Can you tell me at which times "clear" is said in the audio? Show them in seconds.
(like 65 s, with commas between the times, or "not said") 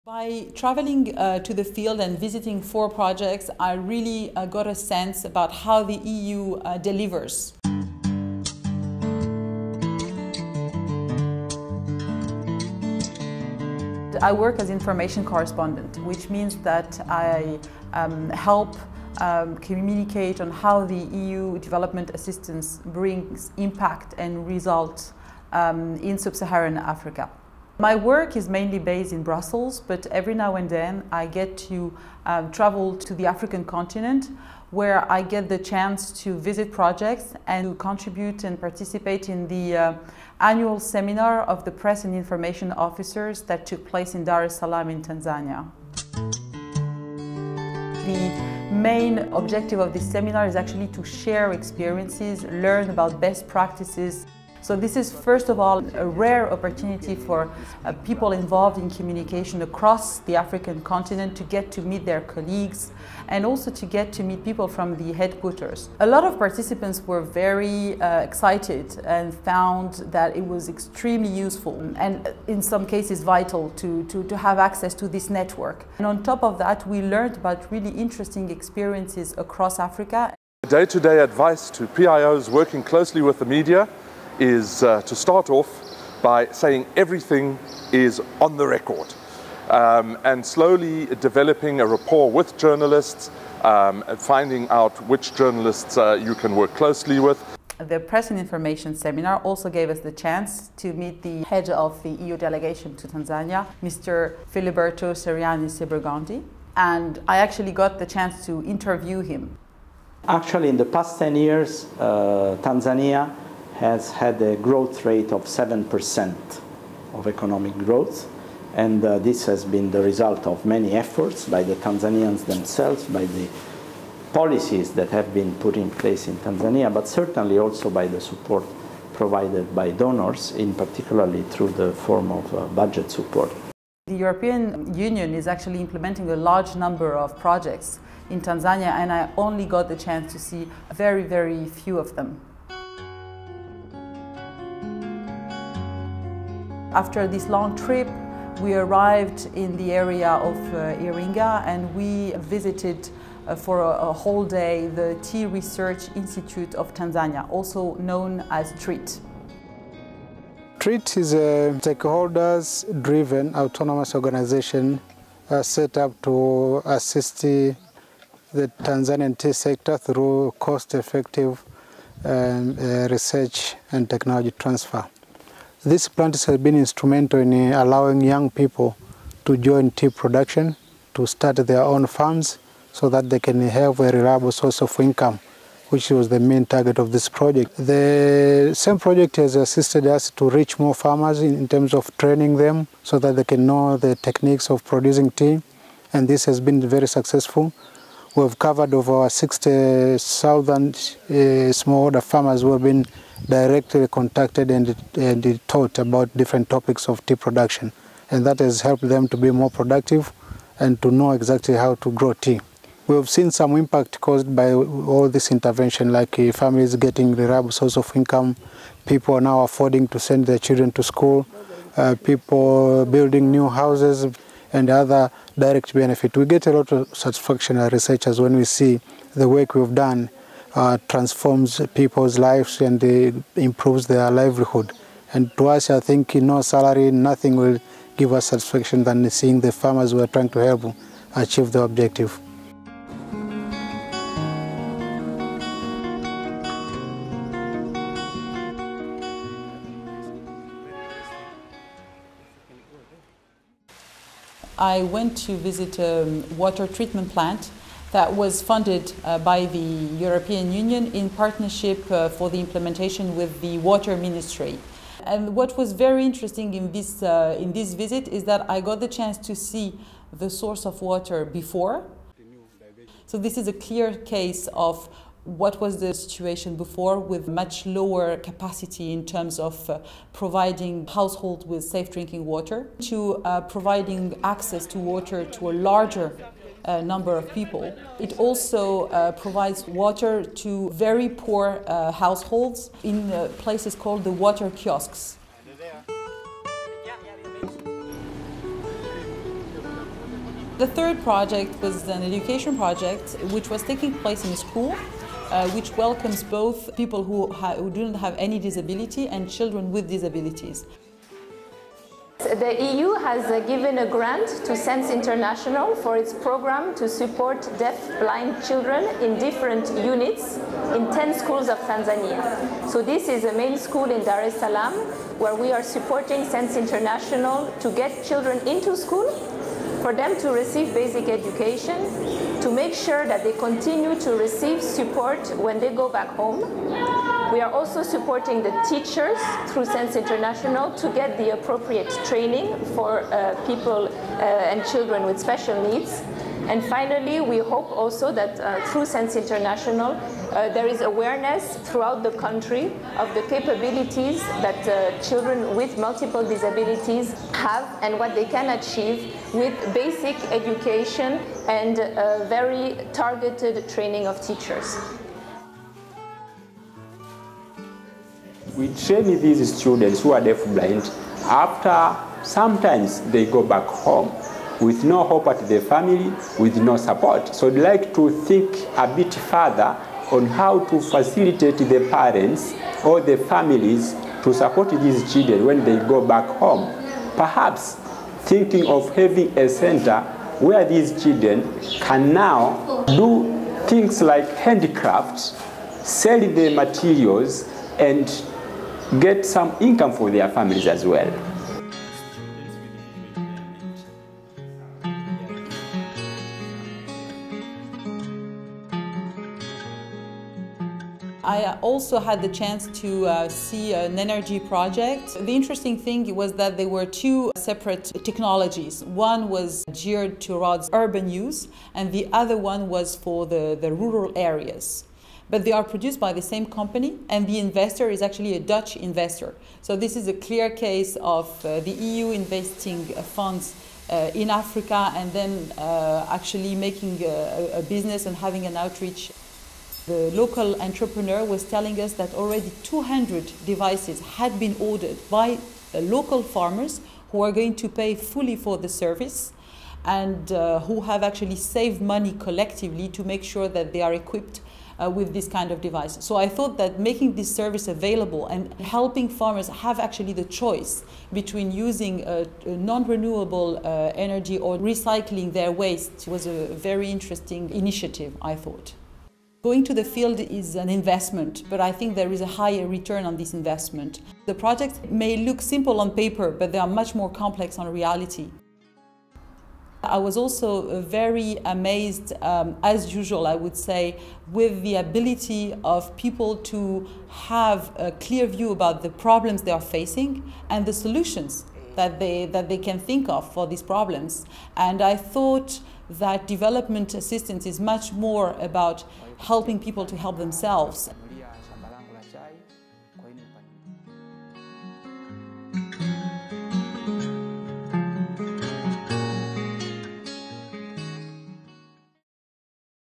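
273 s, 430 s, 488 s.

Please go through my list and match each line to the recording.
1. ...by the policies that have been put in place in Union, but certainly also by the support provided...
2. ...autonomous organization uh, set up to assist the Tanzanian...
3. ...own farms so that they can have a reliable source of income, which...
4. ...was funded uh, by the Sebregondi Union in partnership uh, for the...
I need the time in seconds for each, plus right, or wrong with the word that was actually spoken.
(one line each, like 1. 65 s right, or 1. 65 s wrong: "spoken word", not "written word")
1. 123 s wrong: "Tanzania", not "Union"
2. 163 s right
3. 181 s right
4. 258 s wrong: "European", not "Sebregondi".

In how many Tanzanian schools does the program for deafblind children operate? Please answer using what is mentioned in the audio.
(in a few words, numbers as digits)
10.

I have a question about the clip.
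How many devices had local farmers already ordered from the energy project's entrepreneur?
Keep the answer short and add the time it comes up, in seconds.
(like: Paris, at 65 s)
200, at 442 s.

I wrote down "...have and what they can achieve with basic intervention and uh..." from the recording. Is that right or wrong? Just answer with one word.
wrong.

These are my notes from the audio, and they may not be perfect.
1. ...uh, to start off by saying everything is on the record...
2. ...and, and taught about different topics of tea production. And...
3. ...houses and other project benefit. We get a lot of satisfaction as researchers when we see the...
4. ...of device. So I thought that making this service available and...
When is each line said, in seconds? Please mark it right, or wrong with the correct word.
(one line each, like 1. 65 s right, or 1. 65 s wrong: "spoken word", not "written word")
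1. 84 s right
2. 204 s right
3. 223 s wrong: "direct", not "project"
4. 455 s right.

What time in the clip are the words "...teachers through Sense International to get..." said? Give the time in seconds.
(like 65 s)
338 s.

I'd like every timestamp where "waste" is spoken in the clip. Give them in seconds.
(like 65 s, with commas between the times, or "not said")
465 s.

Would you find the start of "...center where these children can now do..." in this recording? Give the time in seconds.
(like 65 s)
389 s.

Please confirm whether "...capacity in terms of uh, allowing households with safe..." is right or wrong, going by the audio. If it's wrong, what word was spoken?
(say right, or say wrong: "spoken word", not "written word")
wrong: "providing", not "allowing".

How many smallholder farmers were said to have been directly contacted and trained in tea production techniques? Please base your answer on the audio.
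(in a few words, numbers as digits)
60,000.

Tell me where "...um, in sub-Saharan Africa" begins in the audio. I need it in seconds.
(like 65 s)
25 s.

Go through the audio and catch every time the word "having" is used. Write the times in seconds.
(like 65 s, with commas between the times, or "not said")
389 s, 438 s.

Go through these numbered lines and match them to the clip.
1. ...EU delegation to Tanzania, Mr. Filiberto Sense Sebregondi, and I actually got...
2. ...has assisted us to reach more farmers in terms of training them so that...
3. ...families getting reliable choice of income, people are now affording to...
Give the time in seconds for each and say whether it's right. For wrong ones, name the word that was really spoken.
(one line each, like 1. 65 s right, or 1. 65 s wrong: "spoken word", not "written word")
1. 102 s wrong: "Ceriani", not "Sense"
2. 189 s right
3. 216 s wrong: "source", not "choice".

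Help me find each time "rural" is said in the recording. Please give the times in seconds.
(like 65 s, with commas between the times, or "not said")
423 s.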